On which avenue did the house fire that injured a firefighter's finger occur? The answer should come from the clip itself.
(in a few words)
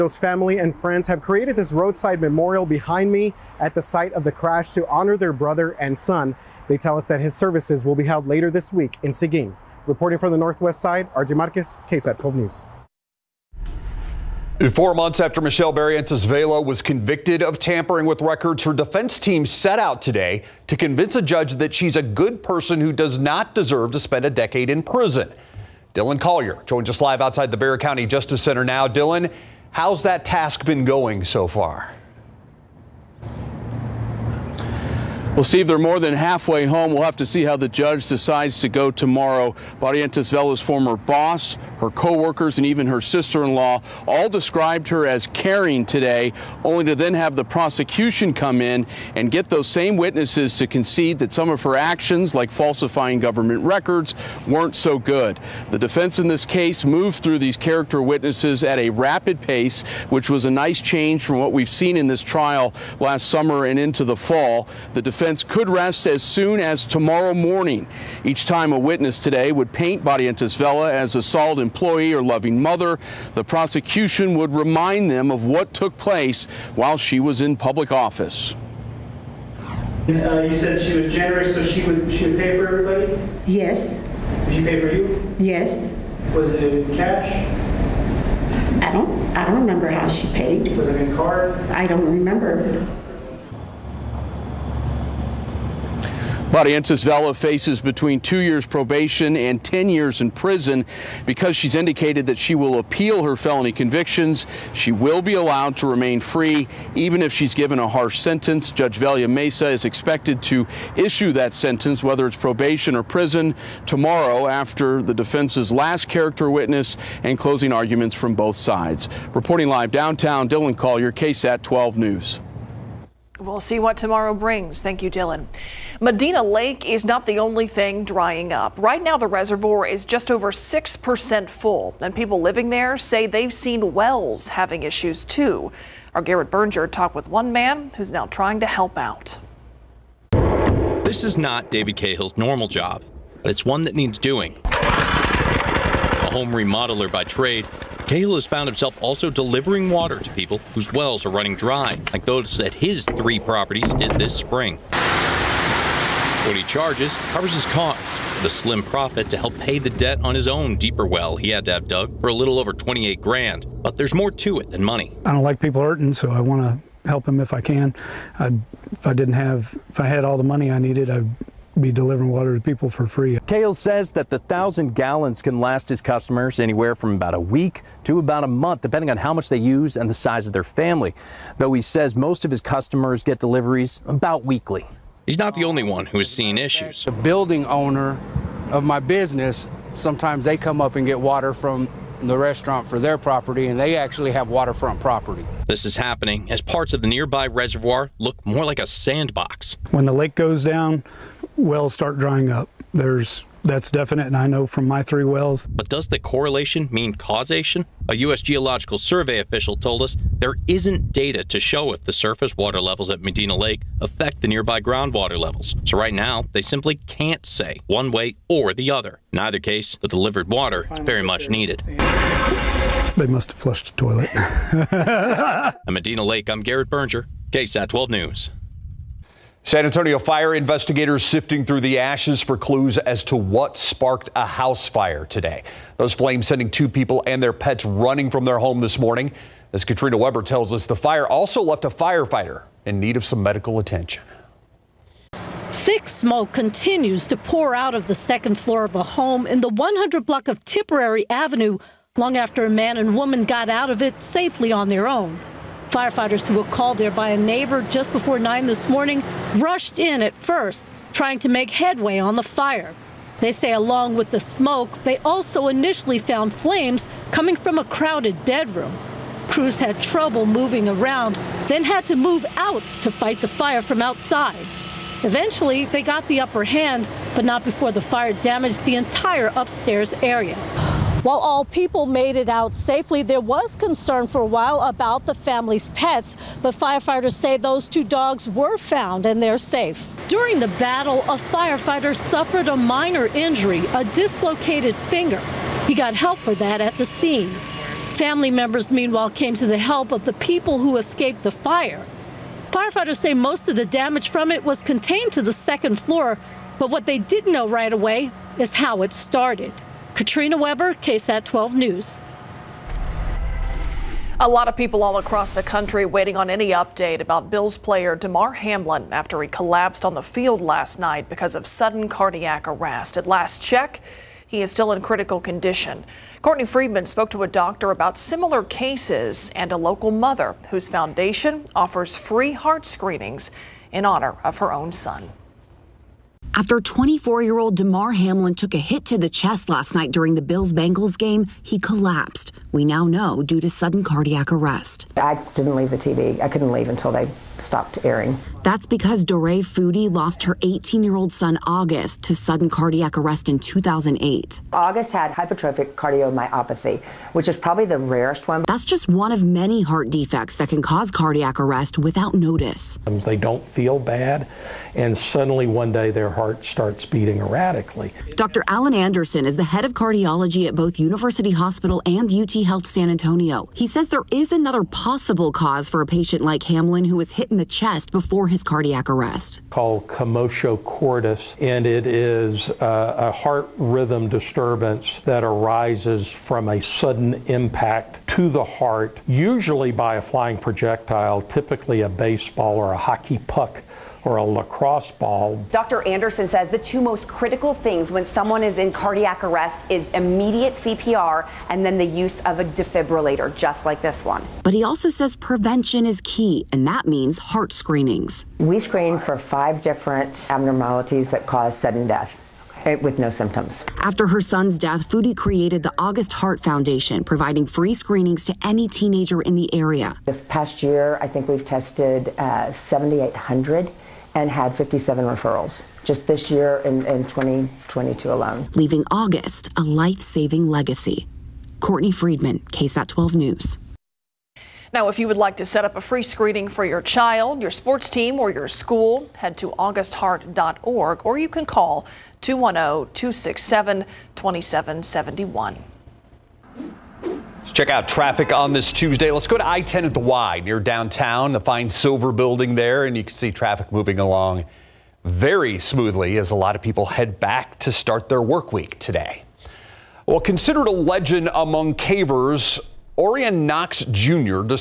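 Tipperary Avenue.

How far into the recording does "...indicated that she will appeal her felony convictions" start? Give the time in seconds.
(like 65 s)
101 s.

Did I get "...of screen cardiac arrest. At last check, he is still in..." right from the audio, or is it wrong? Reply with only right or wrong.
wrong.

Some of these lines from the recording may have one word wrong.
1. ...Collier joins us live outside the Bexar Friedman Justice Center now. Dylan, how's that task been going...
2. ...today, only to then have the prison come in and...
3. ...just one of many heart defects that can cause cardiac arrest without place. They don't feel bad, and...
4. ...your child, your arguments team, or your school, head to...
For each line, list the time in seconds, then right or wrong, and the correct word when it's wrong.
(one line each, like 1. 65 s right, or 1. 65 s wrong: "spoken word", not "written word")
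1. 26 s wrong: "County", not "Friedman"
2. 45 s wrong: "prosecution", not "prison"
3. 358 s wrong: "notice", not "place"
4. 436 s wrong: "sports", not "arguments".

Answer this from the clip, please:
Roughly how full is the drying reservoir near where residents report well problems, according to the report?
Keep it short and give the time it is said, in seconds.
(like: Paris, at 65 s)
just over 6%, at 130 s.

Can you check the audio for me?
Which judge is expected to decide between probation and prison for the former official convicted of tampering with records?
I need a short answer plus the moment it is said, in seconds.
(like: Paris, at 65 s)
Velia Meza, at 108 s.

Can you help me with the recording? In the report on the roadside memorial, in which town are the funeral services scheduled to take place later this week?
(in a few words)
Seguin.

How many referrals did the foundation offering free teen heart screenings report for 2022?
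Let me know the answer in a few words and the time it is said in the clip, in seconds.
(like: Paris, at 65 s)
57, at 424 s.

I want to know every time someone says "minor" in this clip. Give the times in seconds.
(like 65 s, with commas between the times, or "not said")
292 s.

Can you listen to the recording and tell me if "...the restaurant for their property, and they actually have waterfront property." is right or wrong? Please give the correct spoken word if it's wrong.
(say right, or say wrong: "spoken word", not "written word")
right.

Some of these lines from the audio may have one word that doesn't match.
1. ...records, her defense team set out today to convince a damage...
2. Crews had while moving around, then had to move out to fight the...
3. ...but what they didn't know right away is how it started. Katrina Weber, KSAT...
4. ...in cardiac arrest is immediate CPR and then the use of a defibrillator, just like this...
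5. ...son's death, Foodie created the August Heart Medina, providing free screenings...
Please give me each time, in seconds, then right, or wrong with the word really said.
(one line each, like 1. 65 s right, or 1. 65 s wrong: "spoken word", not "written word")
1. 18 s wrong: "judge", not "damage"
2. 269 s wrong: "trouble", not "while"
3. 306 s right
4. 398 s right
5. 414 s wrong: "Foundation", not "Medina".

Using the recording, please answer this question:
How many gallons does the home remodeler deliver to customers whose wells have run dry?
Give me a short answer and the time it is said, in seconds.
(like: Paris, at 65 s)
1000, at 174 s.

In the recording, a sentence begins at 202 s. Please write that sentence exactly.
There's that's definite, and I know from my three wells.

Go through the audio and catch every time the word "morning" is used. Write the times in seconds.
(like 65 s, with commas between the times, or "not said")
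67 s, 238 s, 258 s.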